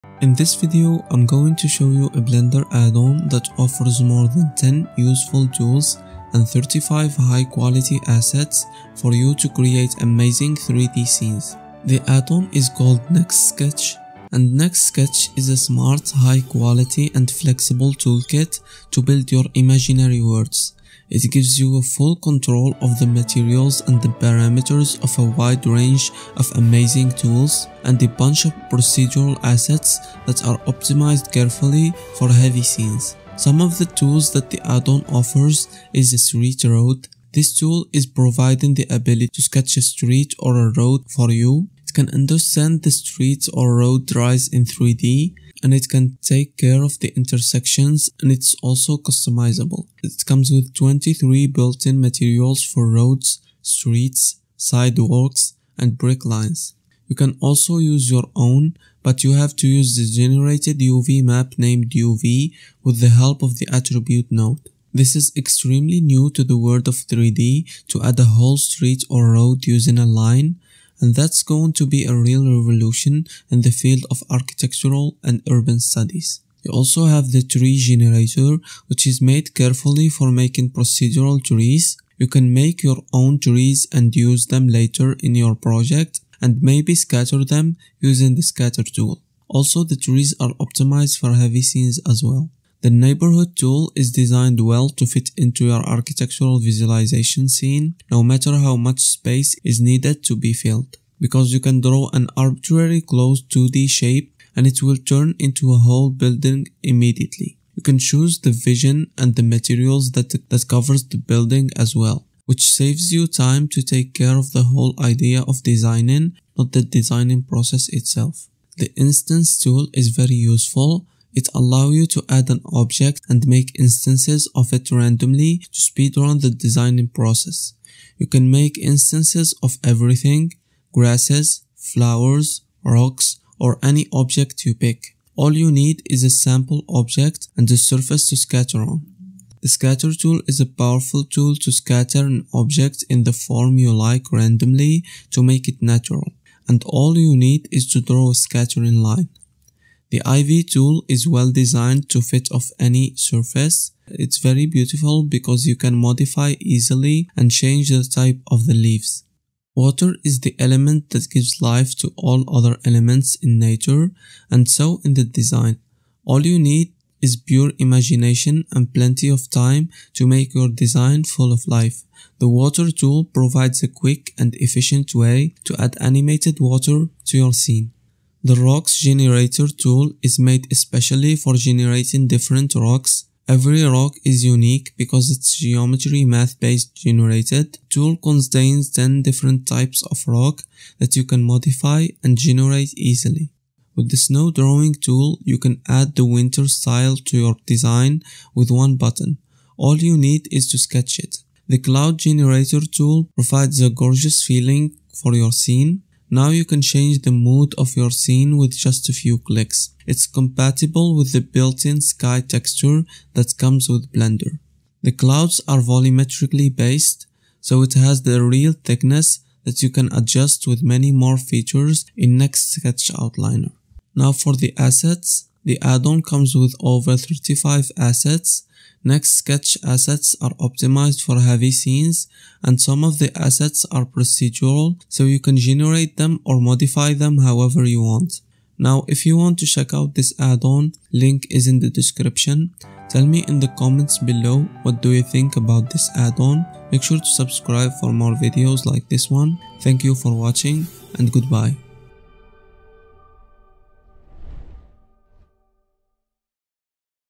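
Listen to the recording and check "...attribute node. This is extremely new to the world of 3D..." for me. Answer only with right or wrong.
right.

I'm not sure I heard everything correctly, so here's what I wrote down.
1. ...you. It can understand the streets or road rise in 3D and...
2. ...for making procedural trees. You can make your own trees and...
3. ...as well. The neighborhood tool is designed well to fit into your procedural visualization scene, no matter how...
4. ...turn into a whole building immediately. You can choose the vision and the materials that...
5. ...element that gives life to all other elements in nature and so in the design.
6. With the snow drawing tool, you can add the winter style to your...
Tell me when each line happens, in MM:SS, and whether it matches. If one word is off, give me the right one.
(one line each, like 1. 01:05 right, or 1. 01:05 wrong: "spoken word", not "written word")
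1. 00:41 right
2. 01:20 right
3. 01:32 wrong: "architectural", not "procedural"
4. 01:44 right
5. 02:40 right
6. 03:13 right.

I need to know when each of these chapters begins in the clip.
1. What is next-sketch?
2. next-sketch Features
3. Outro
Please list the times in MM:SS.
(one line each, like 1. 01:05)
1. 00:14
2. 00:35
3. 04:03.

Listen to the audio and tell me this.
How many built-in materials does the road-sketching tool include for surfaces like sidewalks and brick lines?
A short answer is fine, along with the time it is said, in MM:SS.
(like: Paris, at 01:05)
23, at 00:50.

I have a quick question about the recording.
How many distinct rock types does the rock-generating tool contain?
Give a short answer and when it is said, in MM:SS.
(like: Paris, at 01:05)
10, at 03:08.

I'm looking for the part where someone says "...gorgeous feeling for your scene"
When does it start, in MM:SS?
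03:23.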